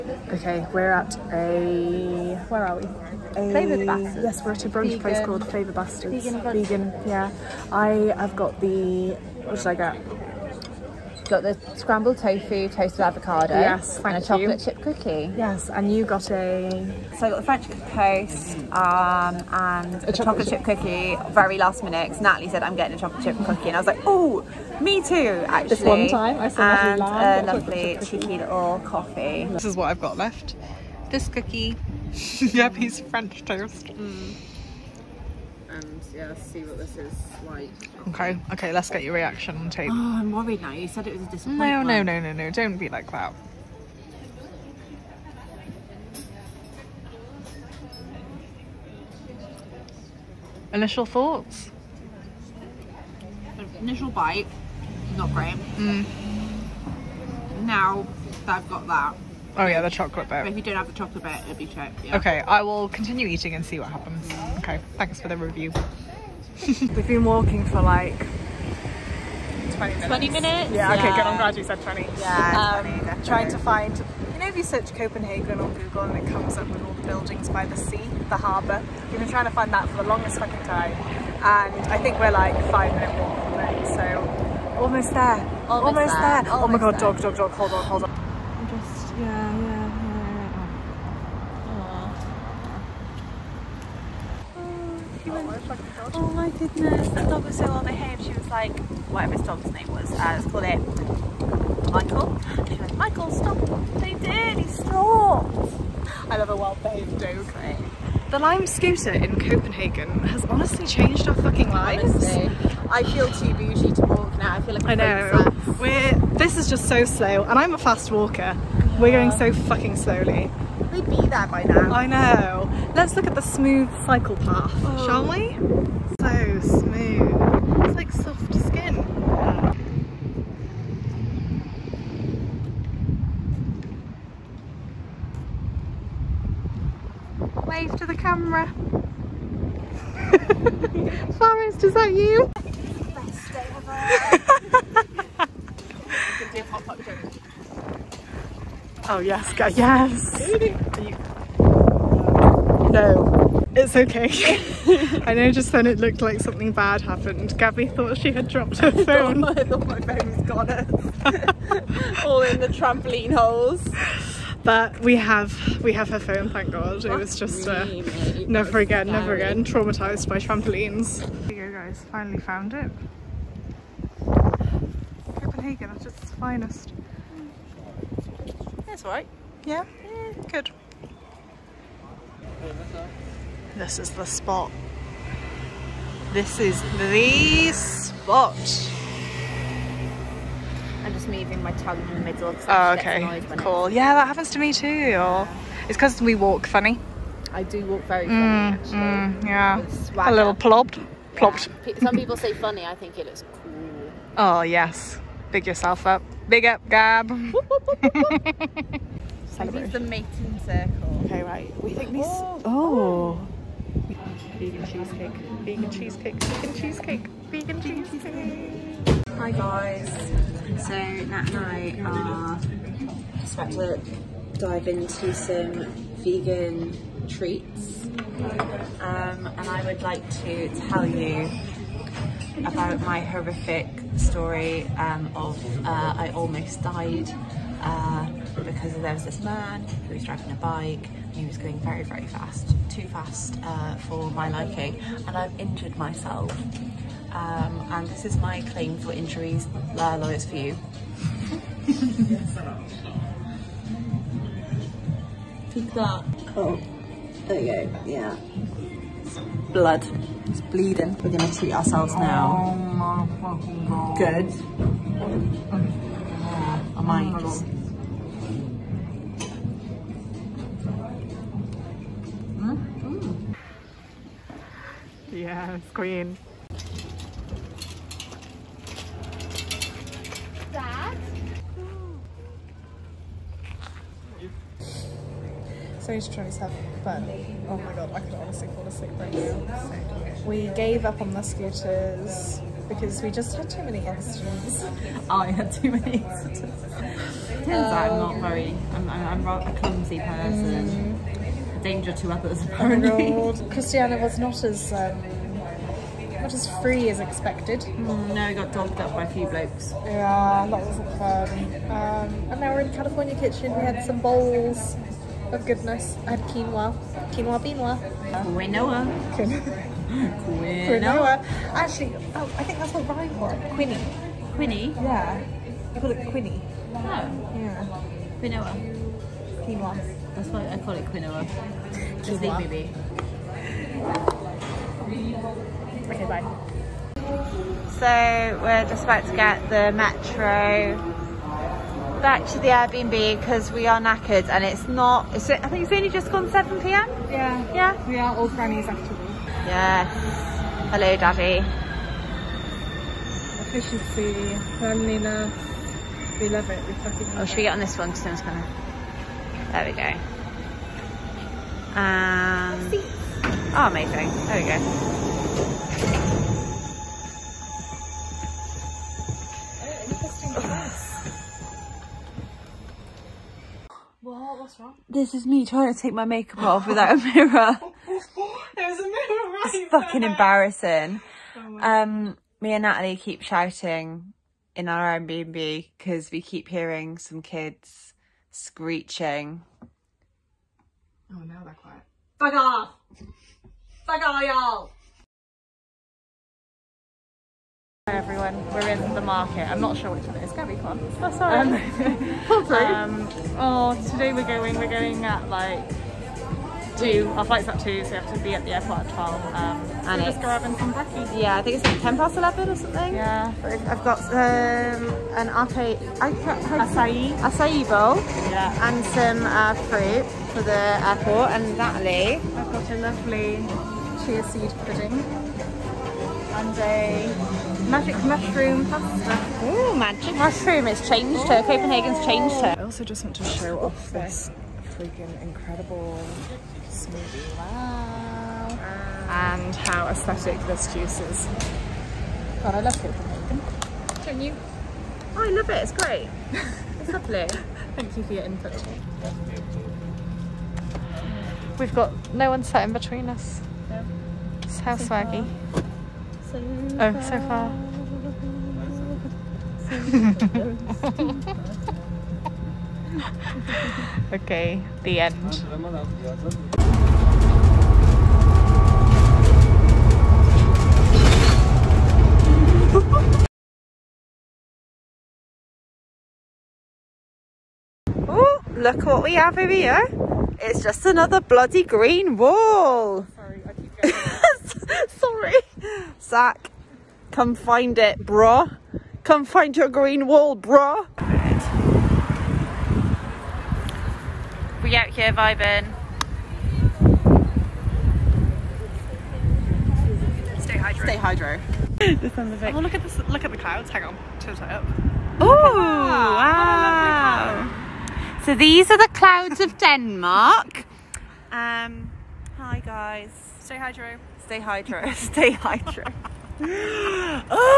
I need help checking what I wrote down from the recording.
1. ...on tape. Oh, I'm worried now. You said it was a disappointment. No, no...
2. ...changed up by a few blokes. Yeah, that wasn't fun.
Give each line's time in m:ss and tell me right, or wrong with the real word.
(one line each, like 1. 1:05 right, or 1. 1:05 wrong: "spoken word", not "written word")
1. 0:39 right
2. 5:08 wrong: "dogged", not "changed".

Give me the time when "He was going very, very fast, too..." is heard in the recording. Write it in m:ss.
4:01.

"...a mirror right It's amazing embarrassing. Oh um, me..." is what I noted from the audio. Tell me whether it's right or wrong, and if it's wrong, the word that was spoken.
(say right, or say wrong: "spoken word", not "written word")
wrong: "fucking", not "amazing".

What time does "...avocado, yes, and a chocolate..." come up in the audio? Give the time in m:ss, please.
0:13.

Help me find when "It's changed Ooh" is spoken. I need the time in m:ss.
7:10.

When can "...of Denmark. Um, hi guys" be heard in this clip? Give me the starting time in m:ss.
8:29.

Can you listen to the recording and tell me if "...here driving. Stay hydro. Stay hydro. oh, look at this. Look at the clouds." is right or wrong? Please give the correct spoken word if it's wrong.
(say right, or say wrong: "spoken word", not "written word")
wrong: "vibing", not "driving".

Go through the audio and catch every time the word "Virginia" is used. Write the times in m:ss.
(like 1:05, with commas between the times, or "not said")
not said.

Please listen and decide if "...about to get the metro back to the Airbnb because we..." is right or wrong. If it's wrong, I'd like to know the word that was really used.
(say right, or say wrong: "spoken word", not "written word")
right.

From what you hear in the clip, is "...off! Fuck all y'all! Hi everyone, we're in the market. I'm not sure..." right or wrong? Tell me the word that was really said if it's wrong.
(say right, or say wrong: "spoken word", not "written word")
right.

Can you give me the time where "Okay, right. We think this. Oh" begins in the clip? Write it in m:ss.
3:31.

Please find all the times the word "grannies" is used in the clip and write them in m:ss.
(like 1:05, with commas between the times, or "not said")
5:48.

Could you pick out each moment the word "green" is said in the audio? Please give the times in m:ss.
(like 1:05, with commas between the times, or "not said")
8:01, 8:09.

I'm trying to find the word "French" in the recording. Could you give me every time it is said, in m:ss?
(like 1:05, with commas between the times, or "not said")
0:17, 0:33.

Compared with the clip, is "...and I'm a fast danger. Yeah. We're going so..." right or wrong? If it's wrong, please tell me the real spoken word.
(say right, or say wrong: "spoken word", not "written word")
wrong: "walker", not "danger".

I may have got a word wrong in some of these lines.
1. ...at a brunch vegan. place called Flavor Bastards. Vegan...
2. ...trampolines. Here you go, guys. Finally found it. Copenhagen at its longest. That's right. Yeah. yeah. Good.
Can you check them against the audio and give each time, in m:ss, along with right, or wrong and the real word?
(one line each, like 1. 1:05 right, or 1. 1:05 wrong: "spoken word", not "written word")
1. 0:04 right
2. 2:50 wrong: "finest", not "longest".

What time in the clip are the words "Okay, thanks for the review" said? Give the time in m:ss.
1:04.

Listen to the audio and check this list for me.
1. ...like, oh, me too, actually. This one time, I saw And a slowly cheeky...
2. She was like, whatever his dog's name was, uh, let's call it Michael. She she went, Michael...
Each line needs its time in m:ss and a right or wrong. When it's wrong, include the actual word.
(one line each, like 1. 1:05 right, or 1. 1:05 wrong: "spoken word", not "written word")
1. 0:23 wrong: "lovely", not "slowly"
2. 1:38 right.